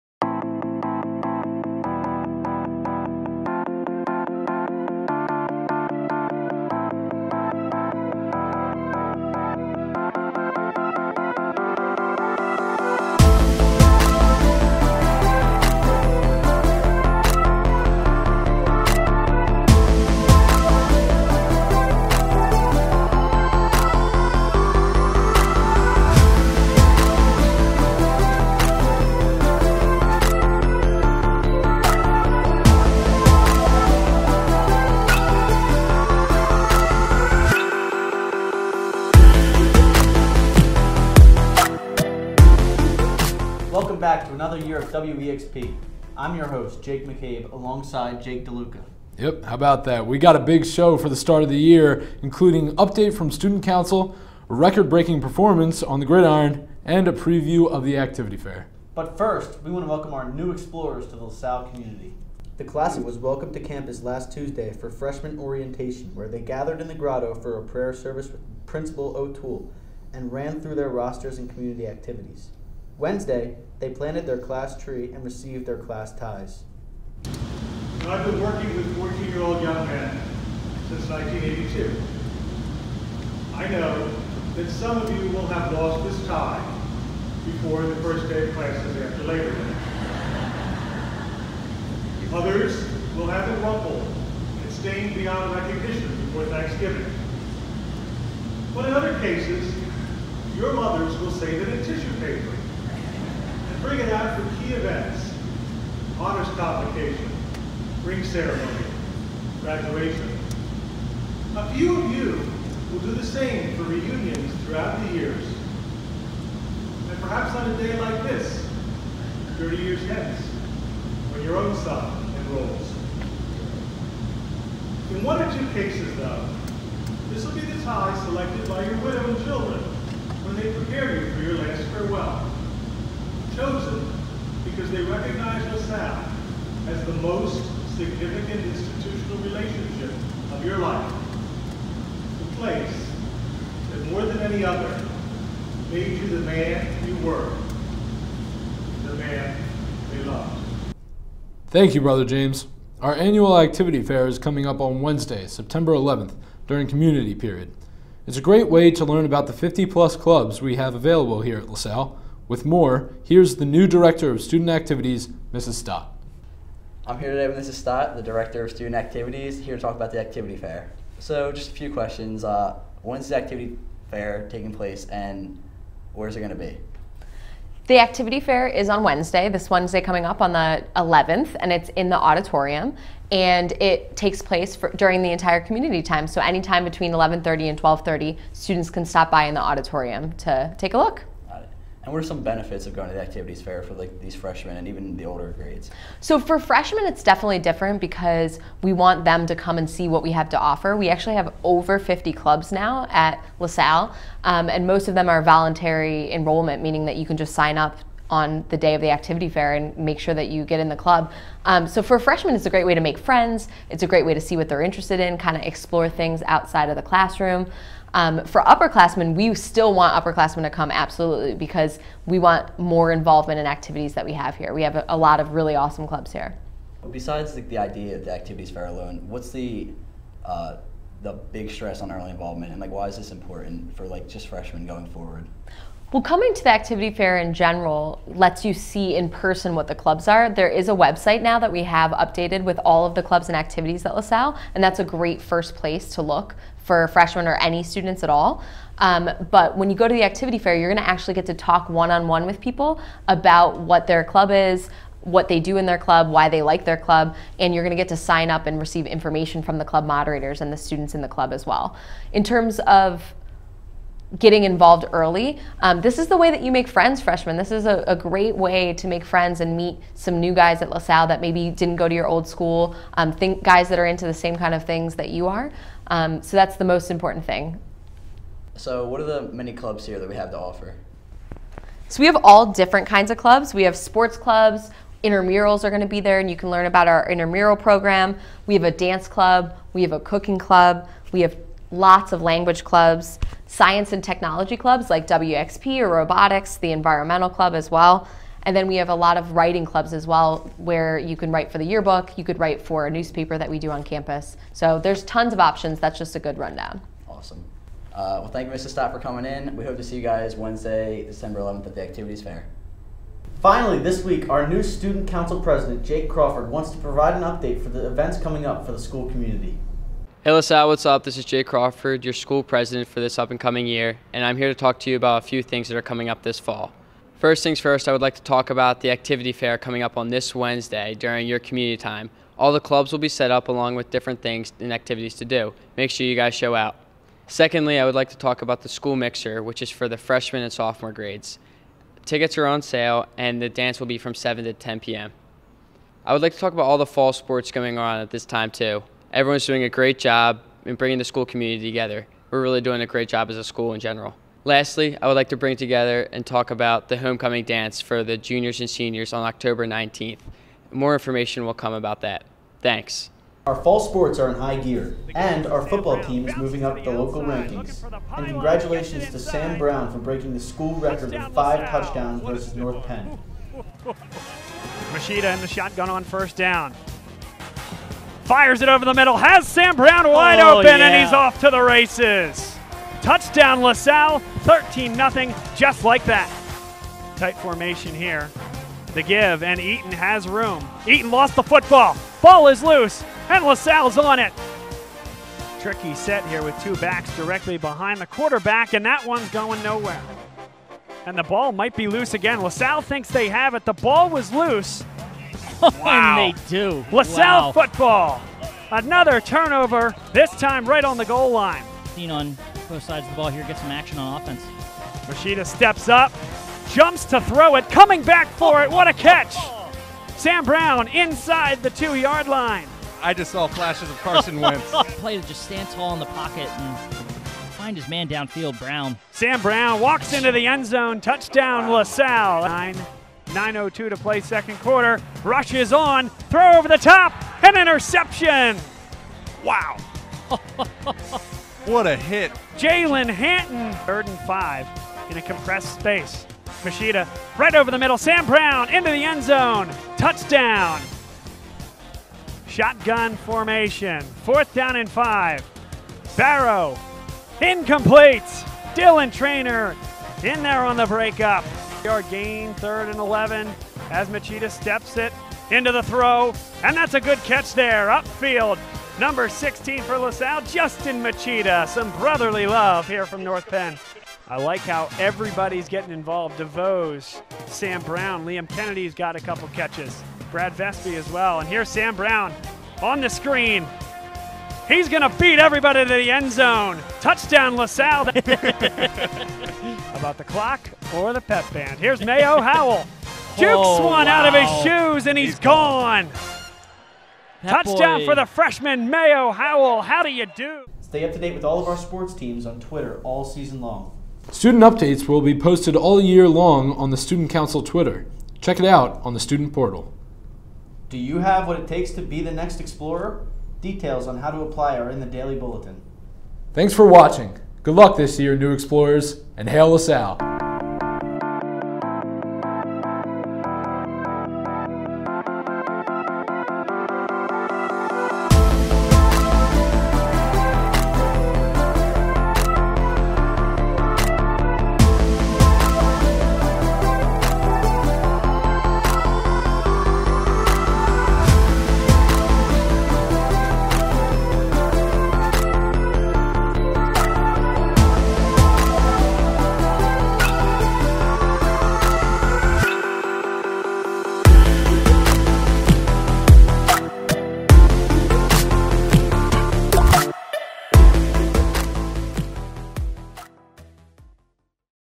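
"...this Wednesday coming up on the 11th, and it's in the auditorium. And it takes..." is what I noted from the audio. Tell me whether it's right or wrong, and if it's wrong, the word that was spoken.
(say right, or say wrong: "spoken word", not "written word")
right.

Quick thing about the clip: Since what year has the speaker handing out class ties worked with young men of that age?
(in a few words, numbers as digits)
1982.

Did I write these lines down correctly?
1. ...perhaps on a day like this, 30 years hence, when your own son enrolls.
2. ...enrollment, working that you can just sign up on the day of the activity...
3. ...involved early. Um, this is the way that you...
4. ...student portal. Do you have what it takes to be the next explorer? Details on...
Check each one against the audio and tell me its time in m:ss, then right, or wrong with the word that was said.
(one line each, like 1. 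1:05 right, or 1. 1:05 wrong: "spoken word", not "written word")
1. 1:57 right
2. 3:26 wrong: "meaning", not "working"
3. 4:24 right
4. 8:29 right.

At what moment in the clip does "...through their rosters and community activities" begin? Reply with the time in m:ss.
1:10.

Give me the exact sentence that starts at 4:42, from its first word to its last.
So we have all different kinds of clubs.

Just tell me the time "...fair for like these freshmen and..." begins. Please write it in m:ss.
3:13.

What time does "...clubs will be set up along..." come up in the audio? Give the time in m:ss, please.
5:32.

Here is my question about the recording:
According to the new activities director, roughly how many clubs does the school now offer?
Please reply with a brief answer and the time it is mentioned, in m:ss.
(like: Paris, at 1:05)
over 50, at 3:21.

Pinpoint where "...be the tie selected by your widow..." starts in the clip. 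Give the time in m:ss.
2:07.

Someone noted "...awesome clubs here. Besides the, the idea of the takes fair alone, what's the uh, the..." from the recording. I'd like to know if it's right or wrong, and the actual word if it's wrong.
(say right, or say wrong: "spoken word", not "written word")
wrong: "activities", not "takes".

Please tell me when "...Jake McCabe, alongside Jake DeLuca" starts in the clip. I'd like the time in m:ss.
0:46.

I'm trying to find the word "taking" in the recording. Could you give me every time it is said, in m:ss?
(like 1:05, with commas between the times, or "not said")
2:54.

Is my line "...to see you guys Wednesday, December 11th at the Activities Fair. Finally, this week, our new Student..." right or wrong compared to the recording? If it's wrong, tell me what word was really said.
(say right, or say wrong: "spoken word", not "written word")
right.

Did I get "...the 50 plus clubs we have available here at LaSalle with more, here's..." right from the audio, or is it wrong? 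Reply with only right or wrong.
right.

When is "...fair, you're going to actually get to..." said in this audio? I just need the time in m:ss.
4:10.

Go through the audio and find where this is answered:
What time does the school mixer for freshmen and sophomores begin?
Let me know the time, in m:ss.
5:44.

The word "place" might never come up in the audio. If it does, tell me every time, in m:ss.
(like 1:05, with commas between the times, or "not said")
2:22, 2:54, 3:04, 4:05.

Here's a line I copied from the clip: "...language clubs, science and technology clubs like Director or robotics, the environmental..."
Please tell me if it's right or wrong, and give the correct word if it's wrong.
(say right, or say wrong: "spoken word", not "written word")
wrong: "WEXP", not "Director".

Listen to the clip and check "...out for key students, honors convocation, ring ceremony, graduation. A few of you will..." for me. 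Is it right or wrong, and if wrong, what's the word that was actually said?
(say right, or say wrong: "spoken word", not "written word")
wrong: "events", not "students".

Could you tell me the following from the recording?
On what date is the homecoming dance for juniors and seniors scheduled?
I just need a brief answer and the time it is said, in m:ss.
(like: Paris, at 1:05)
October 19th, at 5:59.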